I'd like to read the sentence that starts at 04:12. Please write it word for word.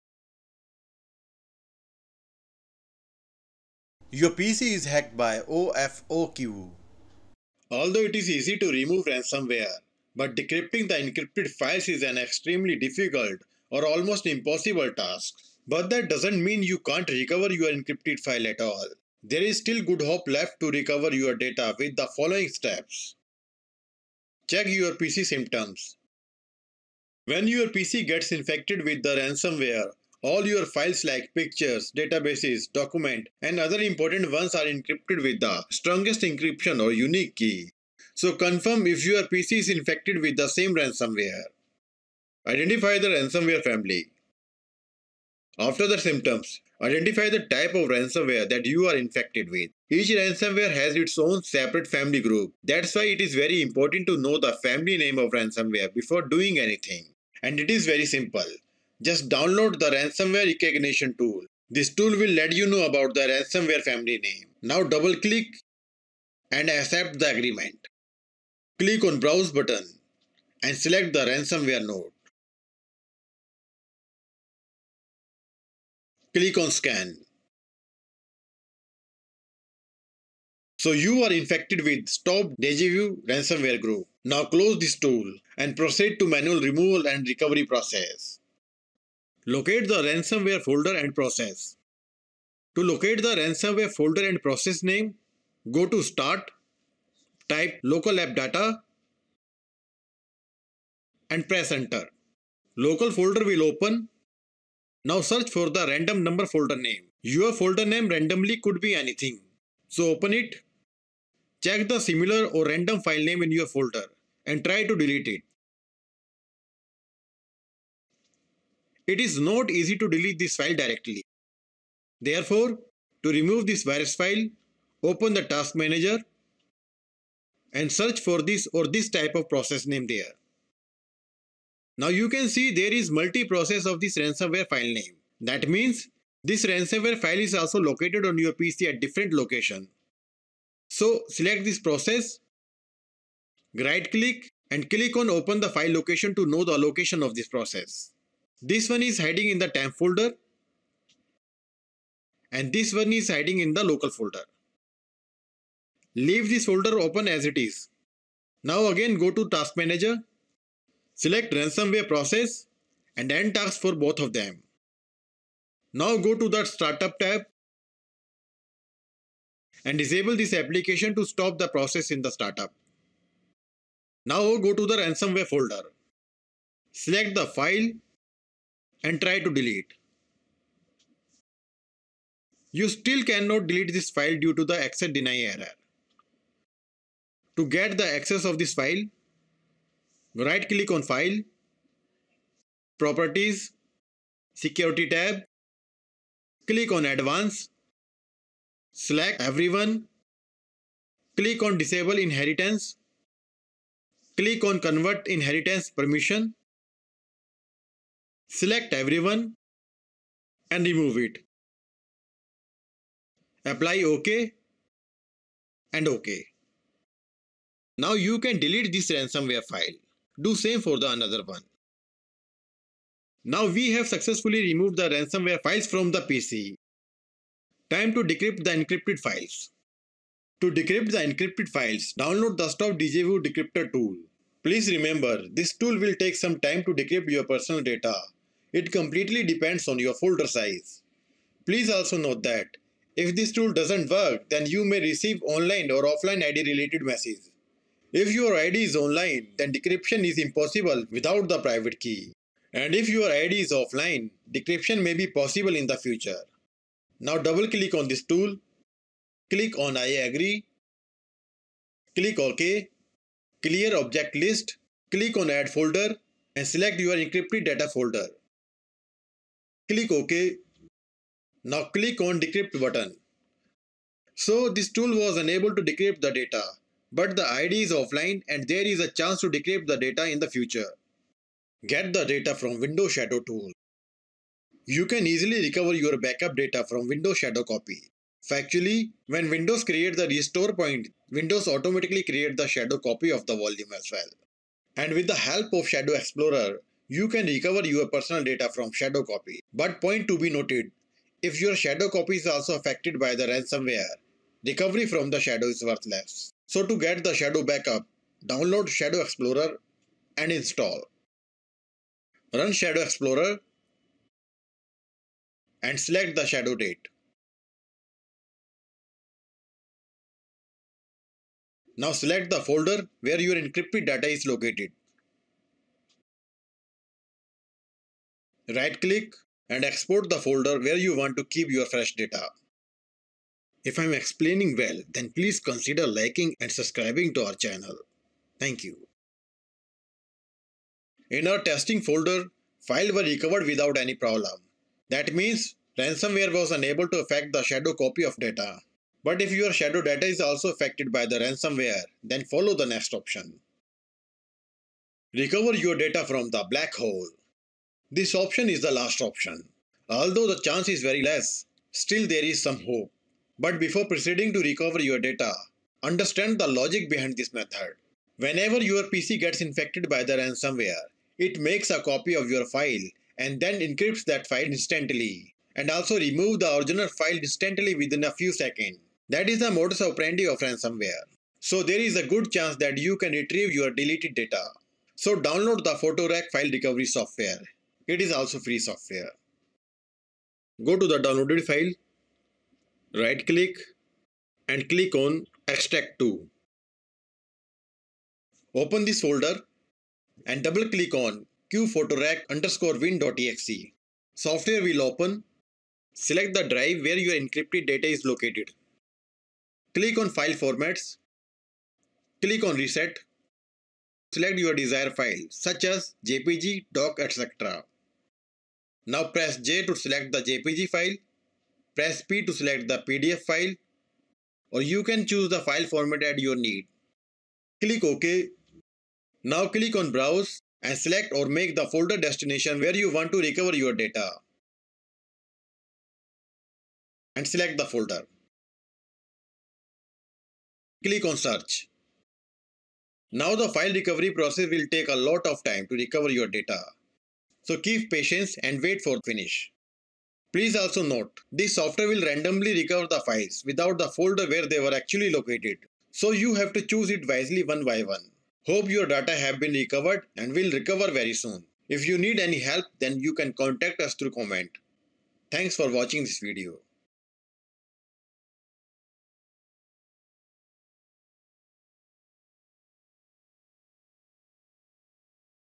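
And if your ID is offline, decryption may be possible in the future.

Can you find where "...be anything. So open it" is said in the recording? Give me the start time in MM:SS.
01:48.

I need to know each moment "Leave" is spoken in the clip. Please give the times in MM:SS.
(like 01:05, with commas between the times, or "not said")
02:36.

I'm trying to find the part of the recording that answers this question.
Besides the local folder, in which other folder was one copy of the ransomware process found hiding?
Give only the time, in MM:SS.
02:29.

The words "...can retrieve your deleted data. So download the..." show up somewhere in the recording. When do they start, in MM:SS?
06:23.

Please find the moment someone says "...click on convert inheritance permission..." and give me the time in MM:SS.
03:24.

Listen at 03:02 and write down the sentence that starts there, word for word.
You still cannot delete this file due to the access deny error.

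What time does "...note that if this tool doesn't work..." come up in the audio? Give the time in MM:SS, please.
04:02.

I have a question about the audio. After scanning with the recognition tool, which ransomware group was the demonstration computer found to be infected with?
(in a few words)
Stop Dejavu.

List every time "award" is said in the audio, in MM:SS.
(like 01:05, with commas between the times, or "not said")
not said.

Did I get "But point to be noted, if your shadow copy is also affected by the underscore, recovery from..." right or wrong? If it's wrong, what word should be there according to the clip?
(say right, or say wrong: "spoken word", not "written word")
wrong: "ransomware", not "underscore".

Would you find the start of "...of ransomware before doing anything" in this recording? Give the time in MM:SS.
00:55.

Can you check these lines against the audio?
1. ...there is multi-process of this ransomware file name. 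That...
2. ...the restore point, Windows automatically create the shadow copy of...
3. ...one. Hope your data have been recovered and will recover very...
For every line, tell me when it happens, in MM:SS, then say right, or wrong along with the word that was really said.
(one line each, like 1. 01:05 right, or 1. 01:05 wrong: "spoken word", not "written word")
1. 02:12 right
2. 04:50 right
3. 07:38 right.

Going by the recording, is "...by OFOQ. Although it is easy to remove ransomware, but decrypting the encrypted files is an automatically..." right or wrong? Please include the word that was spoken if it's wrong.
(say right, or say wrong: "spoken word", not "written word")
wrong: "extremely", not "automatically".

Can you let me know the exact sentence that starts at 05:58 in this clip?
This option is the last option.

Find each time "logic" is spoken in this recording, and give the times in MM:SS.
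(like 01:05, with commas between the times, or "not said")
06:06.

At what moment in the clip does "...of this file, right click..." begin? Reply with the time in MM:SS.
03:08.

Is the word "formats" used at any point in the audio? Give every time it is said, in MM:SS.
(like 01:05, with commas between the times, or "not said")
06:50, 07:05.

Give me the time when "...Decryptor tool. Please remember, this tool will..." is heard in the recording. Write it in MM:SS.
03:53.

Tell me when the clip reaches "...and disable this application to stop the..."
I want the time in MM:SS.
02:49.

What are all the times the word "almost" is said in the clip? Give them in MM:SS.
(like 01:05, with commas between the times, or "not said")
00:13.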